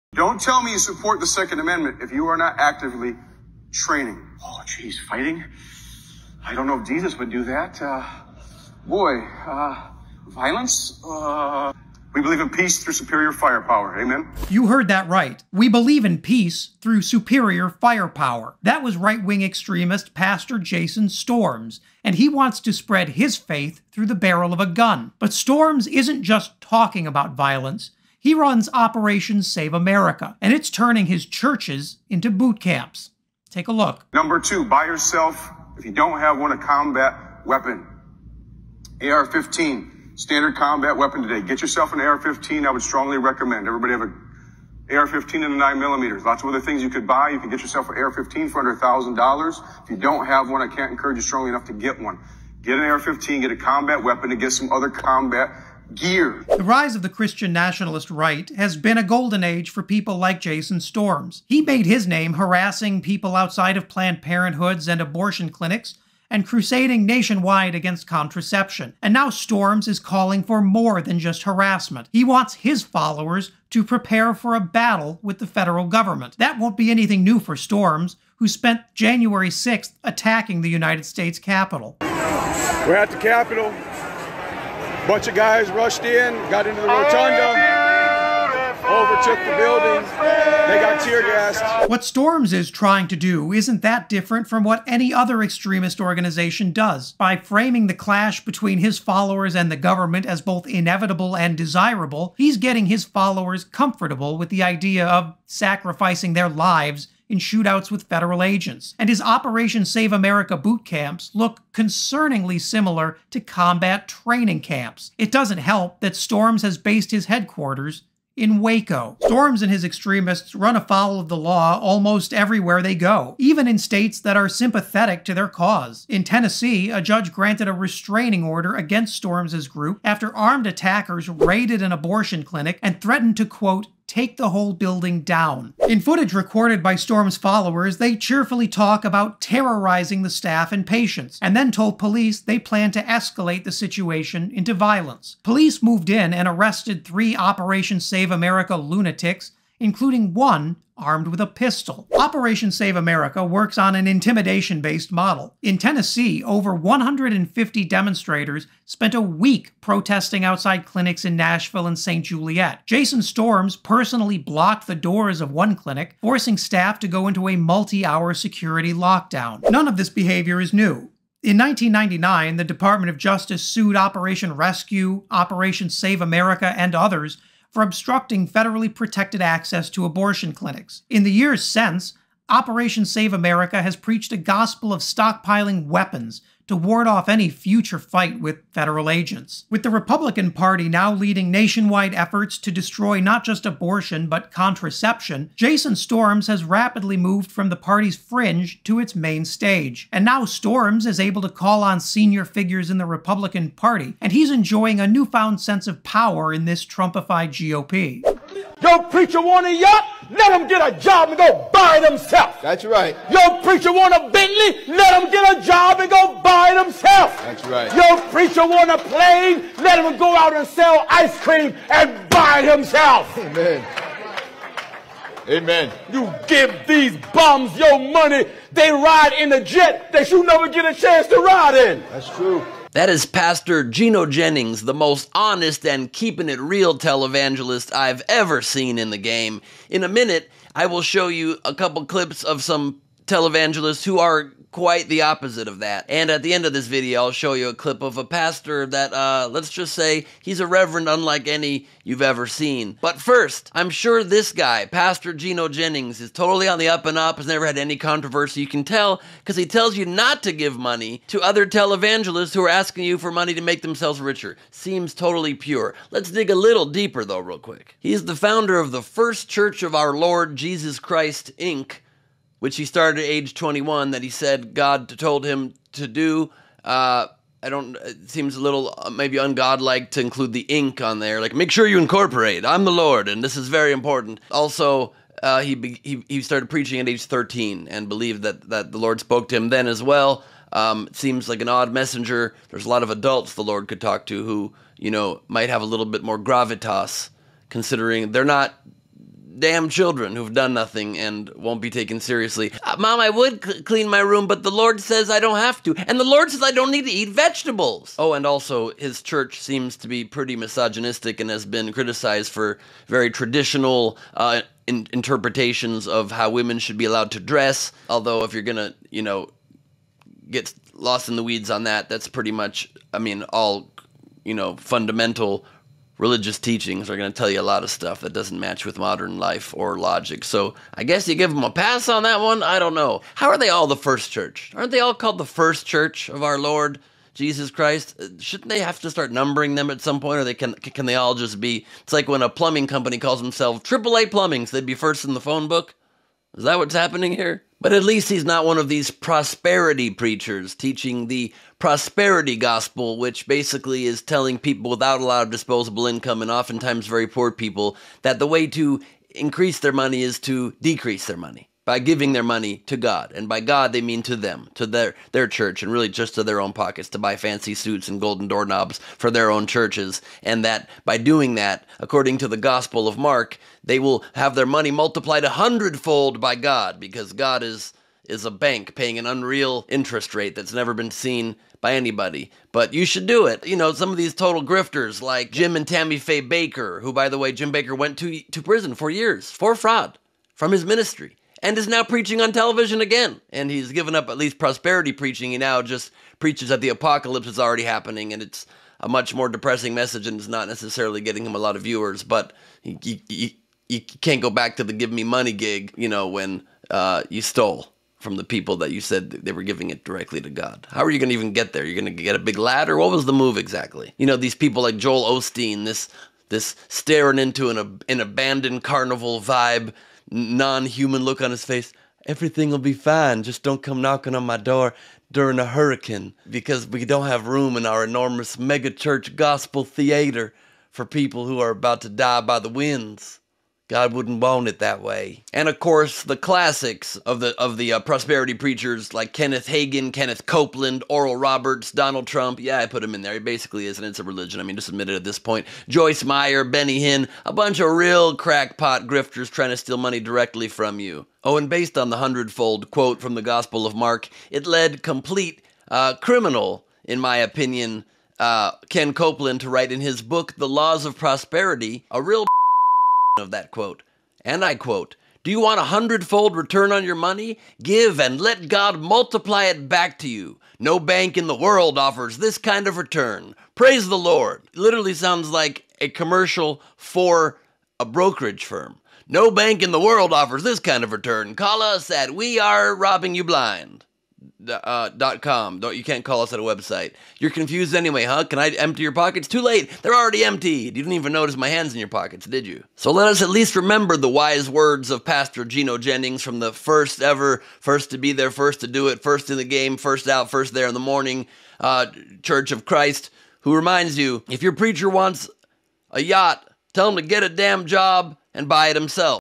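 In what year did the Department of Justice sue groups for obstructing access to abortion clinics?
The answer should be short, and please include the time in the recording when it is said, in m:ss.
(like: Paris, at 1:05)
1999, at 2:51.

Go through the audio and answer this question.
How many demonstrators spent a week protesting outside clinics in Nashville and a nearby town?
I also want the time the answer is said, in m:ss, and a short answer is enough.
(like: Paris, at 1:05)
over 150, at 2:36.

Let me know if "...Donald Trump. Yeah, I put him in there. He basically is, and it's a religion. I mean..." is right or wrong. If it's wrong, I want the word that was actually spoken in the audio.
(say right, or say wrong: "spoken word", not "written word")
right.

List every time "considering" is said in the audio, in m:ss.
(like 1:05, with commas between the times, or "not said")
4:57.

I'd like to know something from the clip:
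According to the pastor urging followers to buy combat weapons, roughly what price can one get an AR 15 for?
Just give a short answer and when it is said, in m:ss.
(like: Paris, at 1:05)
under $1,000, at 0:48.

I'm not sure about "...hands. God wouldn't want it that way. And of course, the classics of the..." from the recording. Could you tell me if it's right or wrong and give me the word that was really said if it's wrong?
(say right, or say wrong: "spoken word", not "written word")
wrong: "winds", not "hands".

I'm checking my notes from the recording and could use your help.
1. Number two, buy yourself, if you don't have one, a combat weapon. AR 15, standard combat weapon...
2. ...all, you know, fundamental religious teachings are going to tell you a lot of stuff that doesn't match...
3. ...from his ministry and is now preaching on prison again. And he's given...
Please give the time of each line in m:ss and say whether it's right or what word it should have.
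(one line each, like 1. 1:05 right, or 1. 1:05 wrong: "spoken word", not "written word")
1. 0:34 right
2. 5:23 right
3. 6:30 wrong: "television", not "prison".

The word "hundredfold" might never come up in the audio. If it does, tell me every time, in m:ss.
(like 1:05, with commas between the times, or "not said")
6:15, 7:32, 7:45.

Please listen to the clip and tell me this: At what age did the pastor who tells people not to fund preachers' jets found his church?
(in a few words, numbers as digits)
21.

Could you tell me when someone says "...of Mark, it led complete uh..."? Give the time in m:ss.
7:33.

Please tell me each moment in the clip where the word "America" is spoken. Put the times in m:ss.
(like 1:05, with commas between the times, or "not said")
0:29, 1:50, 2:28, 2:32, 2:56, 3:03.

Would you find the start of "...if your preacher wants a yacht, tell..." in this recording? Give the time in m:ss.
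8:24.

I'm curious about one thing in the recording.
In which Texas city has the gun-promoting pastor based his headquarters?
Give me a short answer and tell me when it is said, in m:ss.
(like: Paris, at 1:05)
Waco, at 1:58.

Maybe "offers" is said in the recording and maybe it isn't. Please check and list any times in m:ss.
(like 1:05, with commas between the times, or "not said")
7:51, 8:00.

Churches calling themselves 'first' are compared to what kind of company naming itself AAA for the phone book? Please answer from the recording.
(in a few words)
plumbing company.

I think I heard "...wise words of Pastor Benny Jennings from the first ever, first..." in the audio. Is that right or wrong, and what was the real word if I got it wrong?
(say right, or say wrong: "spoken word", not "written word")
wrong: "Gino", not "Benny".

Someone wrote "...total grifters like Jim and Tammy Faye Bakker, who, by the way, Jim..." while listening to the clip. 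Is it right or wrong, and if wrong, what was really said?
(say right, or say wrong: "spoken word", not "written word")
right.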